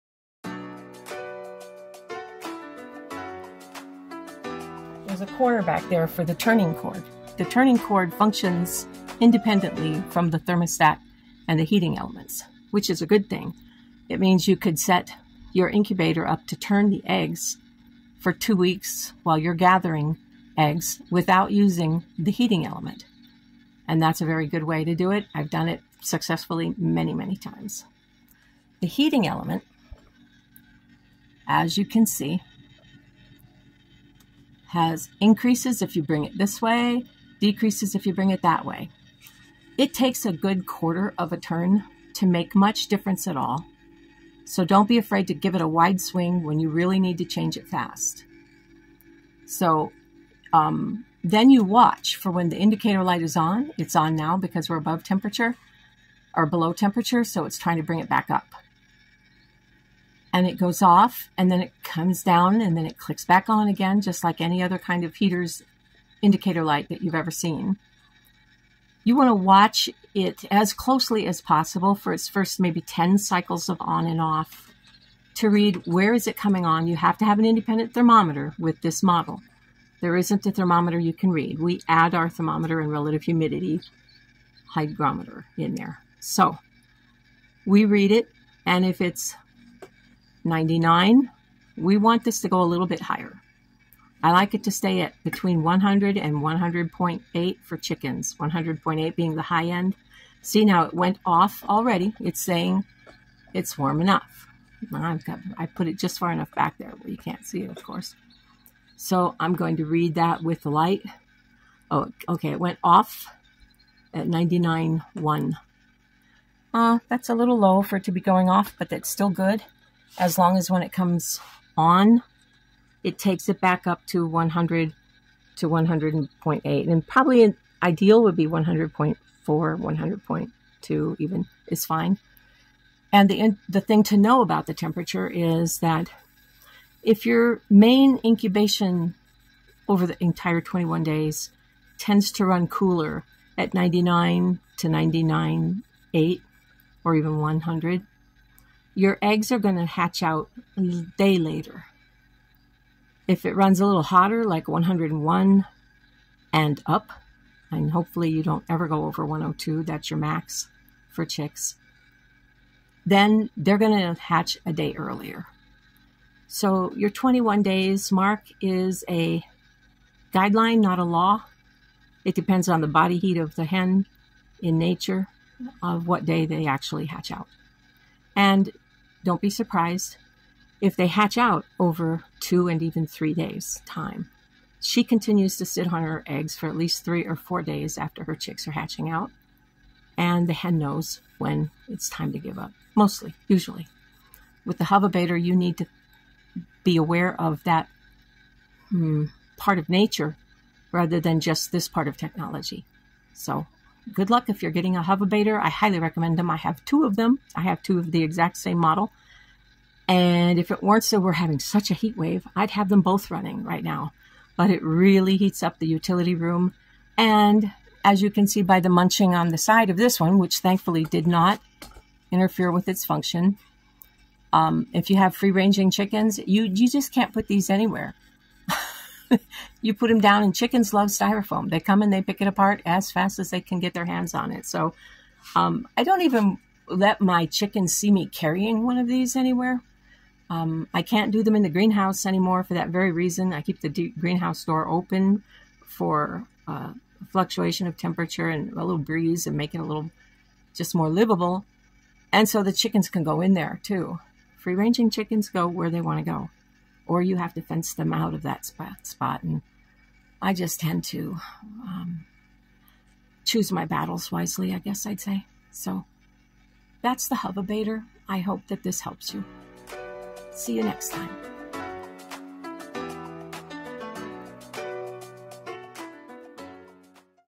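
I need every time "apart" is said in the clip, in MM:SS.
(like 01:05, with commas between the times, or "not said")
03:52.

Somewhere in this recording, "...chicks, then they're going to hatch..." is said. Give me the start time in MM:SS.
02:41.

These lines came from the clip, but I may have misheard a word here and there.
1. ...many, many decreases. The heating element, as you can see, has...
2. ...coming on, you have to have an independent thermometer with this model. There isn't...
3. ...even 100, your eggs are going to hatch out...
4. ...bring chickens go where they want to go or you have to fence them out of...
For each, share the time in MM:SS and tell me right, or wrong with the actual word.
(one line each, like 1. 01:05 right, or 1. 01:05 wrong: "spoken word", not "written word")
1. 00:26 wrong: "times", not "decreases"
2. 01:16 right
3. 02:27 right
4. 04:14 wrong: "ranging", not "bring".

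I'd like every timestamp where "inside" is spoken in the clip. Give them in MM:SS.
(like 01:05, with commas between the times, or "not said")
not said.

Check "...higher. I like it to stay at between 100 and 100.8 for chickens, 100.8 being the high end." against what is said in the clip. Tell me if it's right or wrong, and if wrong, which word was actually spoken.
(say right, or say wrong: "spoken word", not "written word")
right.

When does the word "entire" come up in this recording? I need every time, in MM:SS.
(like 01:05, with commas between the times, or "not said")
02:20.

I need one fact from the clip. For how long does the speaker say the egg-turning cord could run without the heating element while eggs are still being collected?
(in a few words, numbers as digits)
two weeks.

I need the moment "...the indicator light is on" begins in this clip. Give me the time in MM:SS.
00:52.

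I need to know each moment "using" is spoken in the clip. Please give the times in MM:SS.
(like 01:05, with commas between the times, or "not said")
00:21.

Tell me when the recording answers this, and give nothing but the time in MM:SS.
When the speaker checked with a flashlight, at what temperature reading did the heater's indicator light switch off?
01:54.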